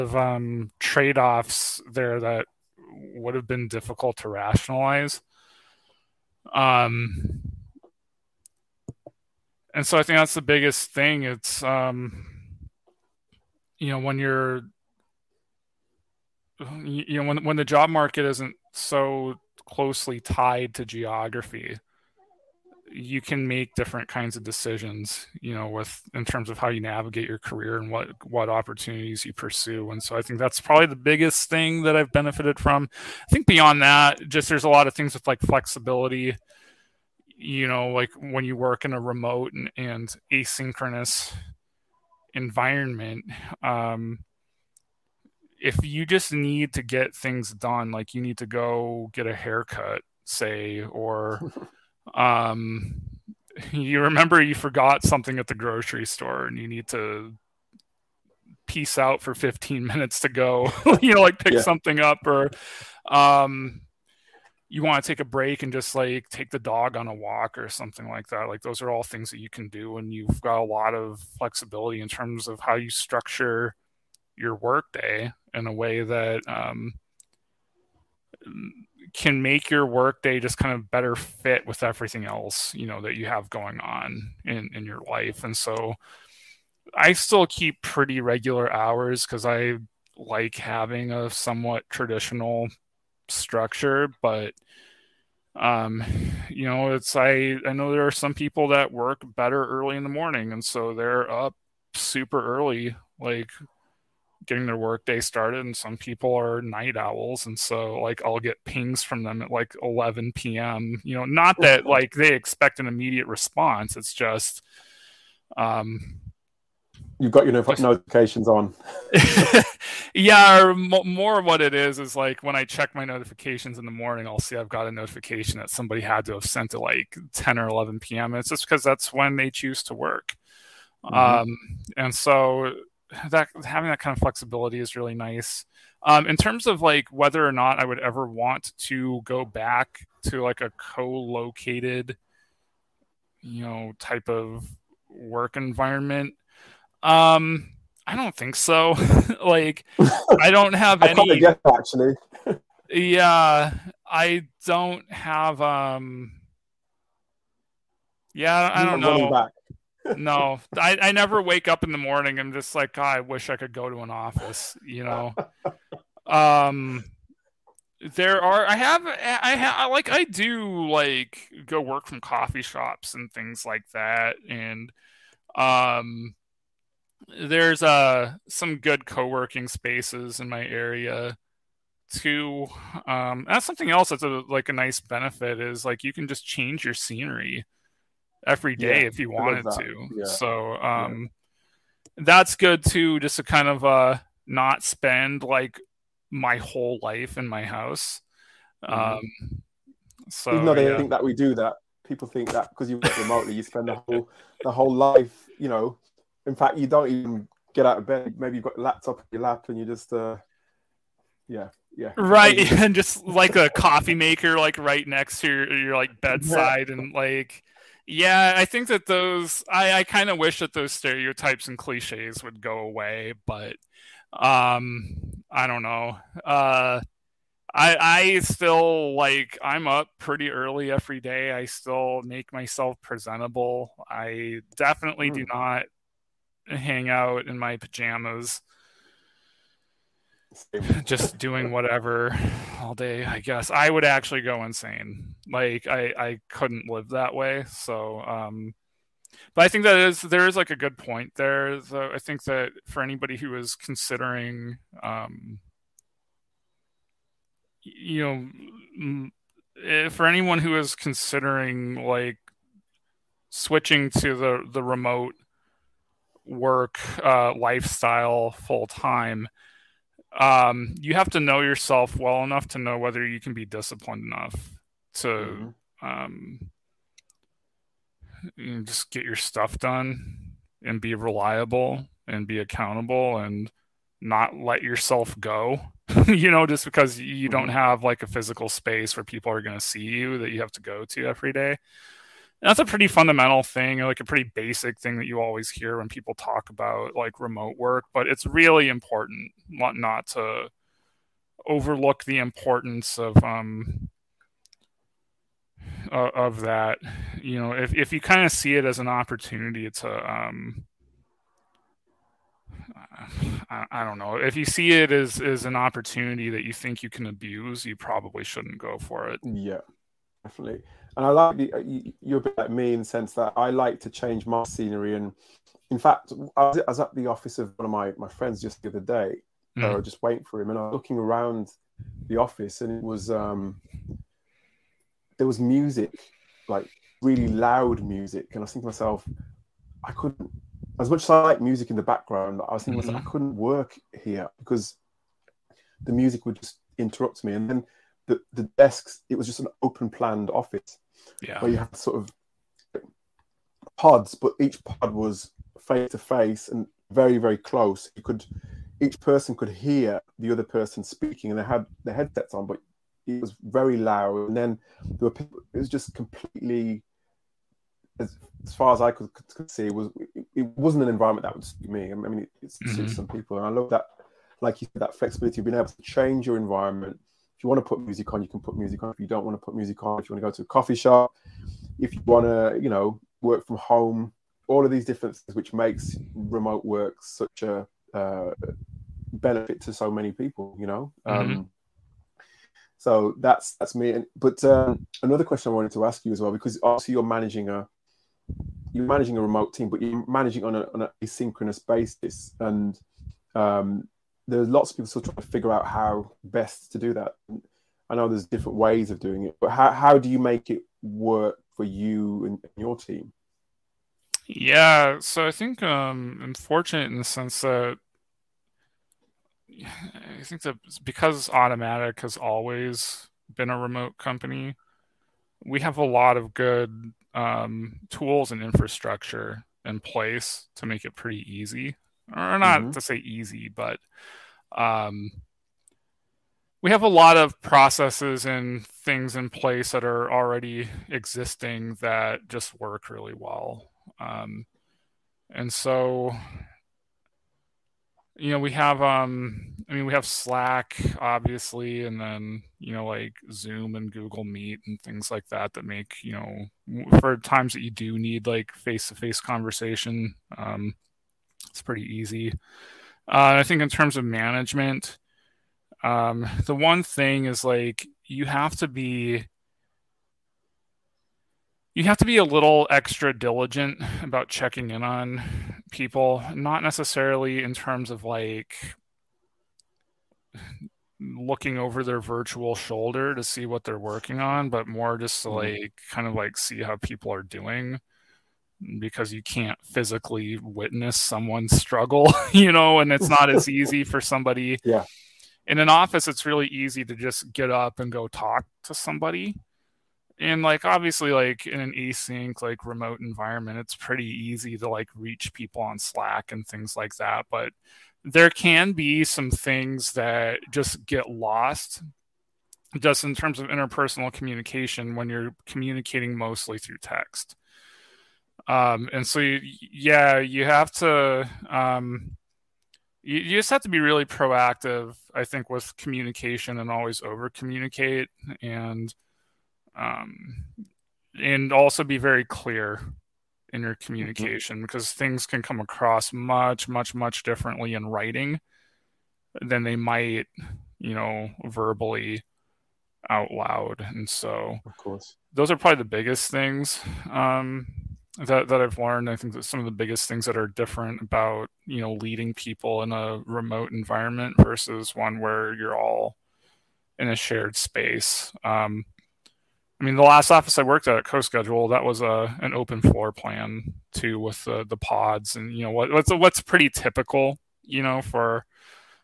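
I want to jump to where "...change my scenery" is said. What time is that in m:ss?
5:24.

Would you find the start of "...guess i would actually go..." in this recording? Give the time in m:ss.
4:03.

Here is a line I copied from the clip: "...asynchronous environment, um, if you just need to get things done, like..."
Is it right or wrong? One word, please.
right.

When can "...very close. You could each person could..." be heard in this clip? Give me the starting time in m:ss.
5:57.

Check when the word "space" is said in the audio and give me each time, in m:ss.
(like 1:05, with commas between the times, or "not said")
2:59, 4:48, 9:17.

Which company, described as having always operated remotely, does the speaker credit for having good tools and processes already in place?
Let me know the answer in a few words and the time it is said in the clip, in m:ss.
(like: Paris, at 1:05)
Automattic, at 7:01.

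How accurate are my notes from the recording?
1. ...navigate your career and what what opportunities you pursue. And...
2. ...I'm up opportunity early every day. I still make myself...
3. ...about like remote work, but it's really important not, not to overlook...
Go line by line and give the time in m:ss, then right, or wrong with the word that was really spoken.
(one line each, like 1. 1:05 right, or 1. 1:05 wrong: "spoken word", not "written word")
1. 0:26 right
2. 3:49 wrong: "pretty", not "opportunity"
3. 4:56 right.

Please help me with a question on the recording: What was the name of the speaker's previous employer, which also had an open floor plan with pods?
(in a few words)
CoSchedule.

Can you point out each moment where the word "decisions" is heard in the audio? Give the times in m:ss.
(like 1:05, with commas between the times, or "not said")
0:24.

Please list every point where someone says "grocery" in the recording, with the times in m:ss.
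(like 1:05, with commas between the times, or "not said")
0:55.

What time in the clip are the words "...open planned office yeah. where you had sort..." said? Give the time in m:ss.
5:49.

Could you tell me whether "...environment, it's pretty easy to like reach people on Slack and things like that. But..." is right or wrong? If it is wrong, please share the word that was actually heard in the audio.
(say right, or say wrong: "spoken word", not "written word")
right.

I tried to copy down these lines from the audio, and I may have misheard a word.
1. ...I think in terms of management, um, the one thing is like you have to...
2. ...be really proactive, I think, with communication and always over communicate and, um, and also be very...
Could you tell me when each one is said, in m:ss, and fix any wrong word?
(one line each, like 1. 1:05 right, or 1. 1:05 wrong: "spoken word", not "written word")
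1. 7:43 right
2. 8:43 right.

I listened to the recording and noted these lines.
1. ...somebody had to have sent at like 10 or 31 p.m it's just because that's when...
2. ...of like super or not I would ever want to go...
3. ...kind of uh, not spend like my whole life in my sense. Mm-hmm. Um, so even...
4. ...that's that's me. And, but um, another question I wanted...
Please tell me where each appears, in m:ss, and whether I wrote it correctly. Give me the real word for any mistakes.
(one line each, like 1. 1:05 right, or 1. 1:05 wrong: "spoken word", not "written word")
1. 2:05 wrong: "11", not "31"
2. 2:16 wrong: "whether", not "super"
3. 3:13 wrong: "house", not "sense"
4. 6:33 right.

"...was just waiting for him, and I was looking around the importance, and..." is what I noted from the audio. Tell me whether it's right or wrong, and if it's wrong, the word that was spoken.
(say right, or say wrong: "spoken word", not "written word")
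wrong: "office", not "importance".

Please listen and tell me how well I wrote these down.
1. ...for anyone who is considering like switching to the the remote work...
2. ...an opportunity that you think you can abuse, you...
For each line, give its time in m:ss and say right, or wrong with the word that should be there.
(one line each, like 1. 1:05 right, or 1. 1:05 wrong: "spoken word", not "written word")
1. 4:20 right
2. 5:15 right.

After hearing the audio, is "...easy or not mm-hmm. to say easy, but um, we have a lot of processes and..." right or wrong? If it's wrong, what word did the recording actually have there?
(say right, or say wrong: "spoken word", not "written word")
right.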